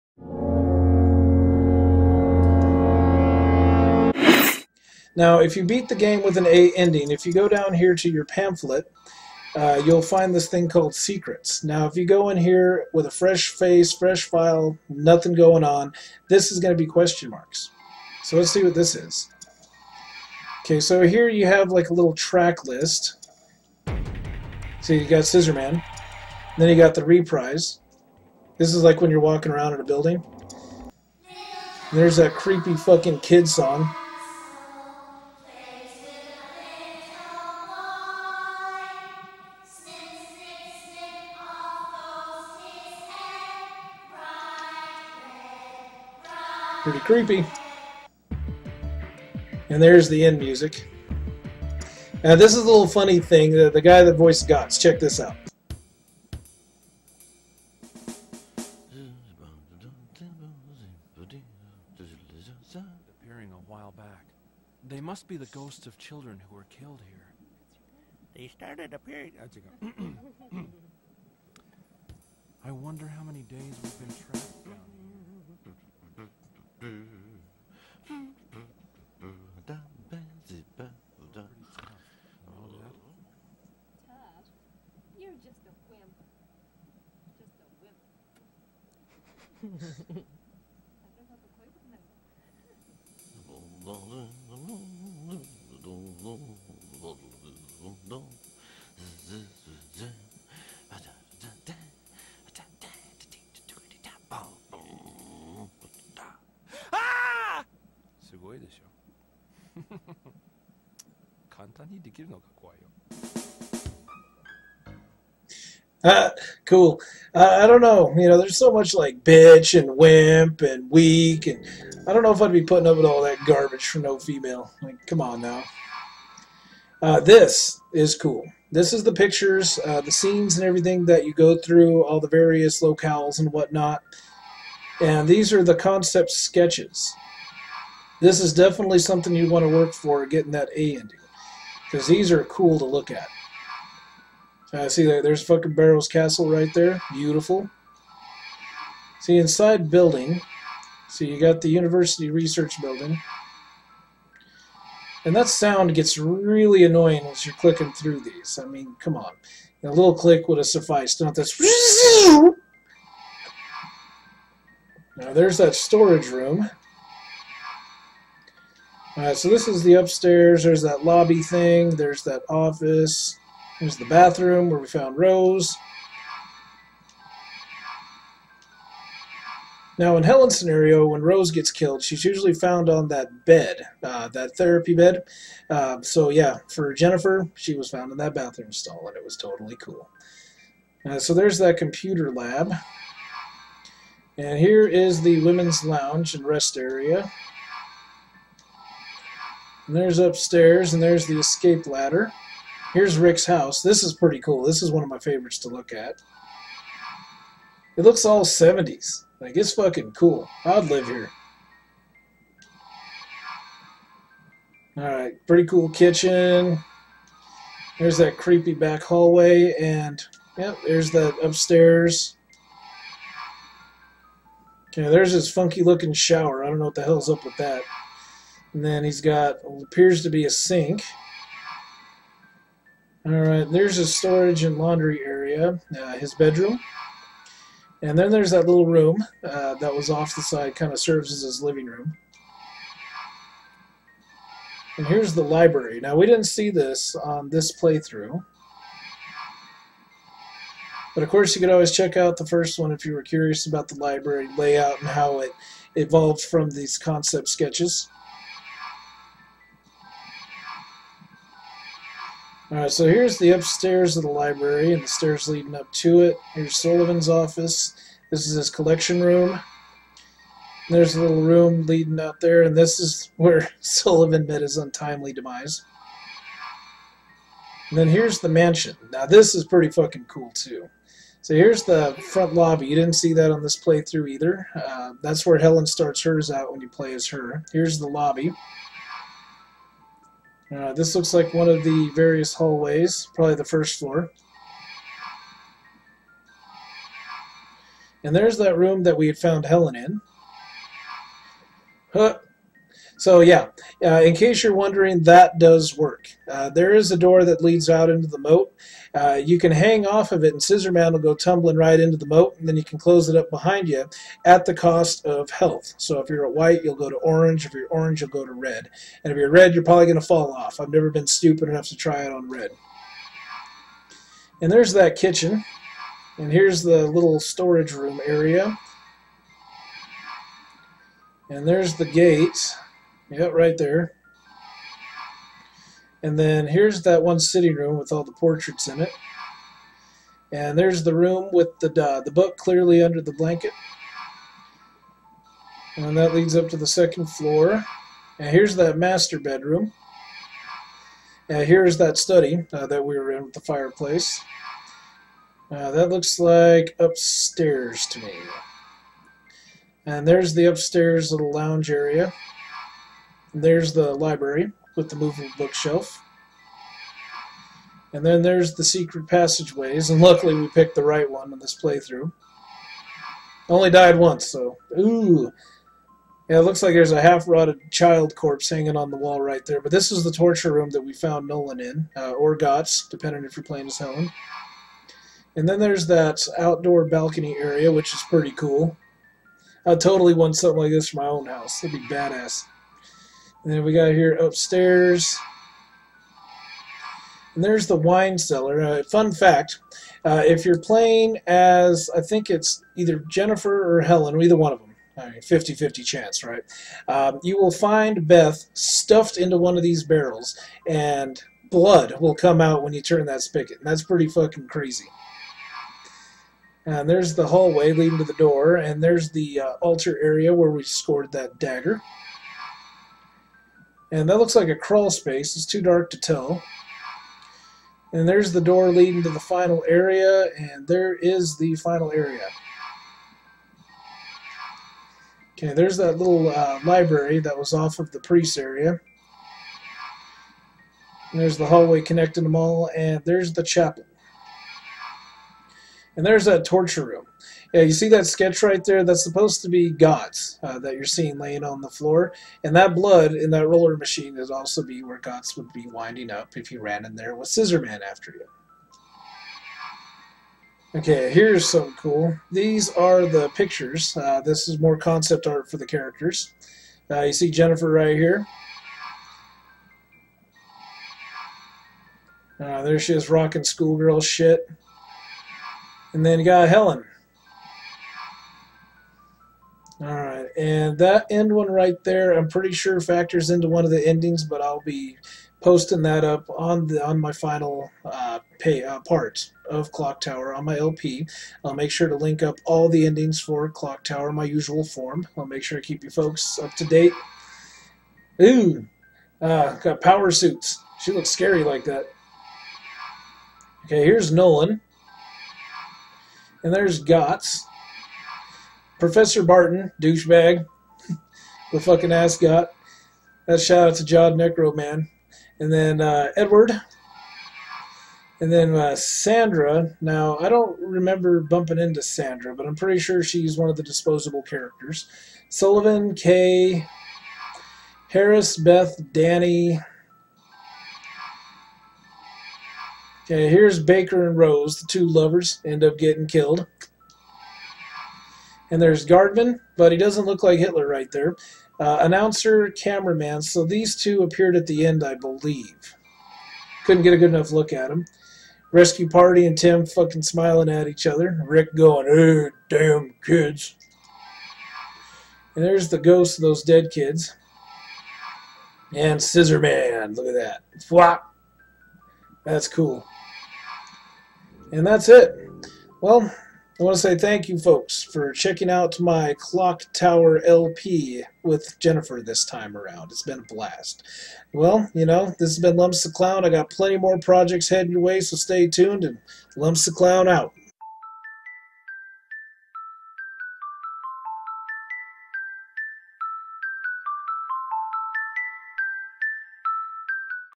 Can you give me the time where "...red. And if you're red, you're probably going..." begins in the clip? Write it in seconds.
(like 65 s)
318 s.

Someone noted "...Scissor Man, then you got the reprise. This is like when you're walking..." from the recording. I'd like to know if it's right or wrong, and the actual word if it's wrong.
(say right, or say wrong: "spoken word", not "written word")
right.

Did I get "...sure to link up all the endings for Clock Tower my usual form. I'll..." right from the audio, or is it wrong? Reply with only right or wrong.
right.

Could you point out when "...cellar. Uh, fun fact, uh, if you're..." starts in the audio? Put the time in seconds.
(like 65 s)
398 s.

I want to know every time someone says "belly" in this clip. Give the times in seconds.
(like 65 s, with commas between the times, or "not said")
not said.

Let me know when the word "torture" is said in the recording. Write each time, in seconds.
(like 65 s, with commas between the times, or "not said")
380 s, 446 s.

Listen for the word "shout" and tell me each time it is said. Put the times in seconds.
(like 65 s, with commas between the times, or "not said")
513 s.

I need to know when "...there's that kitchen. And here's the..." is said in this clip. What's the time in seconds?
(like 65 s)
324 s.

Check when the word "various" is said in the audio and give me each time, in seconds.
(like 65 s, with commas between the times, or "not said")
132 s, 292 s.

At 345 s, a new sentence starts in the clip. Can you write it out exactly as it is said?
And that leads up to the second floor.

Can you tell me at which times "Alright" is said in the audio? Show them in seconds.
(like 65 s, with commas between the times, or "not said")
169 s, 214 s, 262 s.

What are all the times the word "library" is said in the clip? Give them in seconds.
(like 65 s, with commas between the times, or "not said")
245 s, 253 s, 264 s, 364 s, 436 s.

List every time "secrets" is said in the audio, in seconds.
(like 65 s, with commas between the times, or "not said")
10 s, 368 s.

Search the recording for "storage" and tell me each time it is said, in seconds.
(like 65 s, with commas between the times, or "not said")
165 s, 234 s, 327 s.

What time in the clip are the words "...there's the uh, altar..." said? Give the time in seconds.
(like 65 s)
419 s.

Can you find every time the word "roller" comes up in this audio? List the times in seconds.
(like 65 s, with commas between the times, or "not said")
453 s.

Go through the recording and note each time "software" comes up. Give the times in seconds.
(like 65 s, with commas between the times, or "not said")
not said.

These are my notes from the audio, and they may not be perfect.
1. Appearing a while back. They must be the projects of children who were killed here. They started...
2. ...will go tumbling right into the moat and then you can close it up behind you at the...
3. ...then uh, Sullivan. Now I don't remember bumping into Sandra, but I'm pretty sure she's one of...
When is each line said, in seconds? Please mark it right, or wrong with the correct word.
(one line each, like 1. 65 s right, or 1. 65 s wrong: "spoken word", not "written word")
1. 63 s wrong: "ghosts", not "projects"
2. 311 s right
3. 518 s wrong: "Sandra", not "Sullivan".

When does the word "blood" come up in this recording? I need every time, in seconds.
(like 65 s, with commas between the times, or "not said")
411 s, 452 s.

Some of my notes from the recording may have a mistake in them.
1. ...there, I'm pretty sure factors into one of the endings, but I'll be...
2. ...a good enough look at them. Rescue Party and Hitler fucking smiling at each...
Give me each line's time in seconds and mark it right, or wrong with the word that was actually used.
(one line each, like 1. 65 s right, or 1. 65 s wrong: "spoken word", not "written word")
1. 482 s right
2. 547 s wrong: "Tim", not "Hitler".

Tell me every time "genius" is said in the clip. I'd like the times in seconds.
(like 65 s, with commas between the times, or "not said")
not said.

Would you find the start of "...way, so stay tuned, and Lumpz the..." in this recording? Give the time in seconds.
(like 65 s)
578 s.